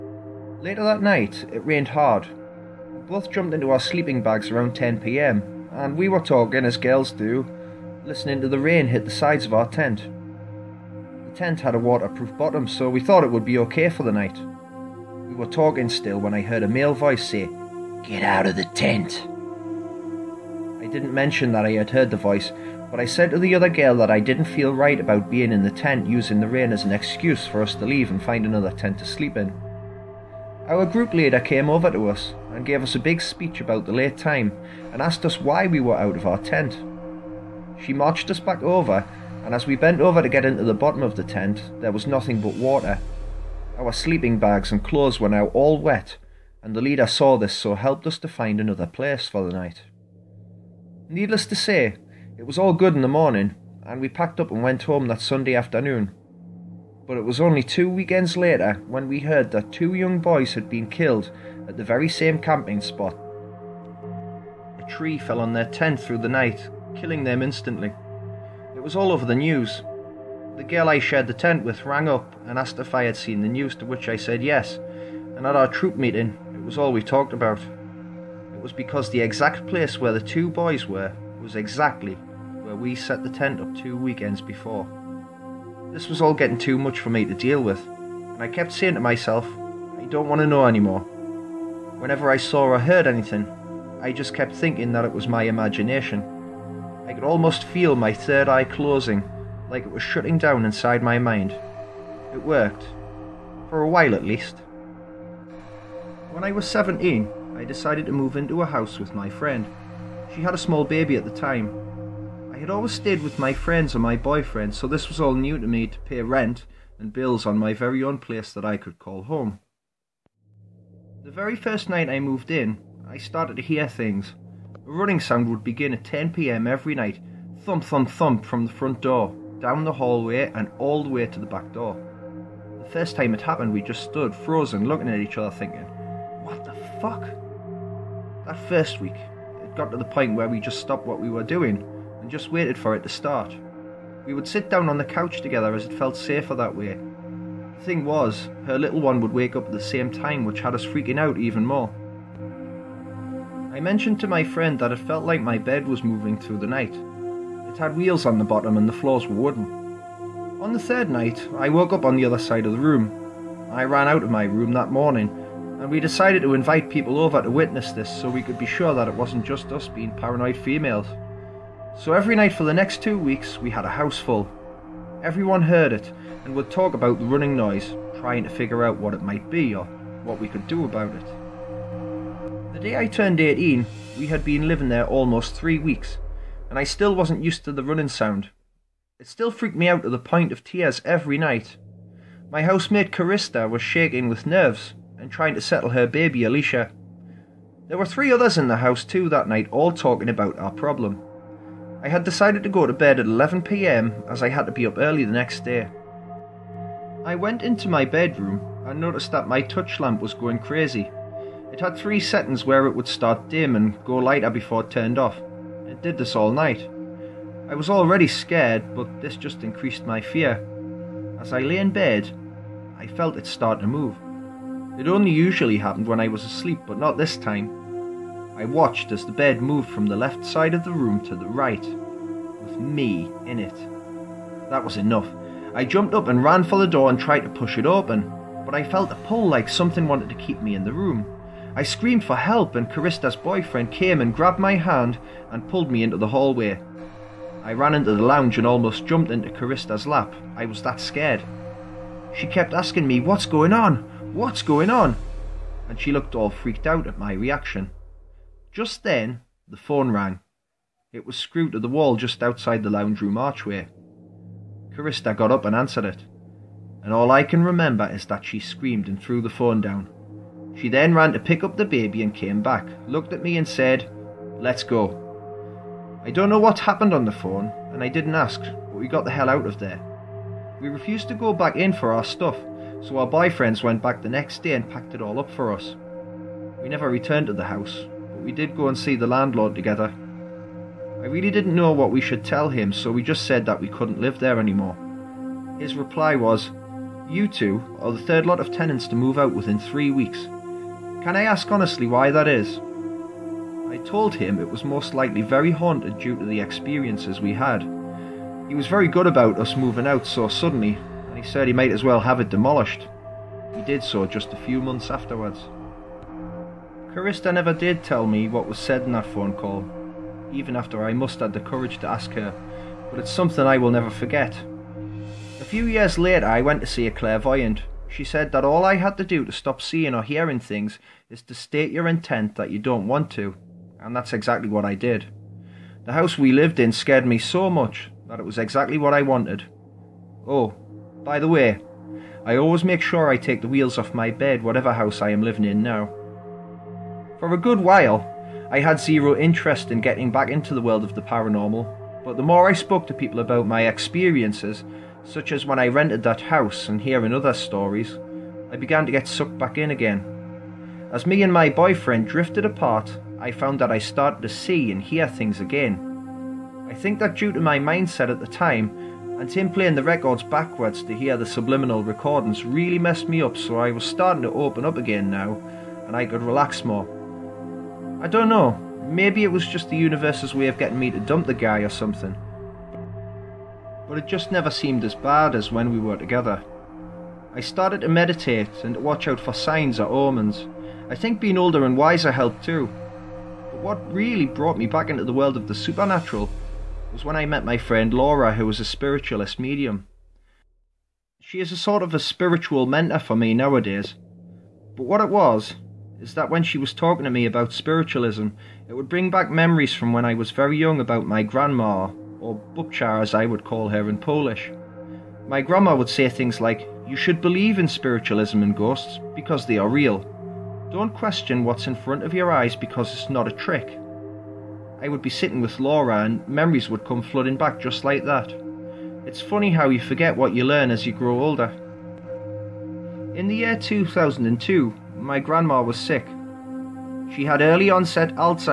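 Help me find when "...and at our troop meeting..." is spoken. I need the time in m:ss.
1:15.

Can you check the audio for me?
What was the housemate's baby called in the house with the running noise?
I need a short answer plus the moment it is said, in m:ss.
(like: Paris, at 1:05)
Alicia, at 3:16.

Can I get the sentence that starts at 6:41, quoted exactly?
She is a sort of a spiritual mentor for me nowadays.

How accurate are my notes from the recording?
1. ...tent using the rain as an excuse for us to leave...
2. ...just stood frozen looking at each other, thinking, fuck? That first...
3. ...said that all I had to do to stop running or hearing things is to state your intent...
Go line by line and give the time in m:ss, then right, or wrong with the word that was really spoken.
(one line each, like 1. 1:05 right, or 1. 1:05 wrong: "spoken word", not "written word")
1. 0:25 right
2. 2:13 right
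3. 5:28 wrong: "seeing", not "running".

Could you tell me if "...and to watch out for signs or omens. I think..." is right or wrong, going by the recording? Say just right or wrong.
right.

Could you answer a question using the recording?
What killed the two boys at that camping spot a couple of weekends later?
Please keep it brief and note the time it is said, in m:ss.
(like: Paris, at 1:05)
A tree fell, at 1:04.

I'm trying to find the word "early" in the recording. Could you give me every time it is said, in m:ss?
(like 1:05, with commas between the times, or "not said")
3:24, 7:17.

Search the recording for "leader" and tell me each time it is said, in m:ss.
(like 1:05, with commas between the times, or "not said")
0:31, 0:46.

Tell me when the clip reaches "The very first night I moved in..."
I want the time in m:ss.
2:01.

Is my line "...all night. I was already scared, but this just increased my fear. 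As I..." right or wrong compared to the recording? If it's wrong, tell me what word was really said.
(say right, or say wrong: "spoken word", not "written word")
right.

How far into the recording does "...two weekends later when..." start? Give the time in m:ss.
0:57.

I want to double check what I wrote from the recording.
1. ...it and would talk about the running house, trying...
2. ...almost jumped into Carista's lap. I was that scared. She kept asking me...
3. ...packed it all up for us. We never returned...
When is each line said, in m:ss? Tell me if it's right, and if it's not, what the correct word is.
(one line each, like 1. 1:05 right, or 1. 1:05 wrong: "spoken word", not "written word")
1. 2:55 wrong: "noise", not "house"
2. 4:08 right
3. 4:44 right.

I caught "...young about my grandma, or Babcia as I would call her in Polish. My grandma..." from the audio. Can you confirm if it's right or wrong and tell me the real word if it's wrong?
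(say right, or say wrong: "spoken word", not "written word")
right.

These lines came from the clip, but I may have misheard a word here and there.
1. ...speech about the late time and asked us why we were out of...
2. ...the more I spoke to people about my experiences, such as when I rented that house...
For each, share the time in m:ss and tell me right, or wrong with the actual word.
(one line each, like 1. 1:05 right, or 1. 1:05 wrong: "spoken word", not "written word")
1. 0:33 right
2. 5:52 right.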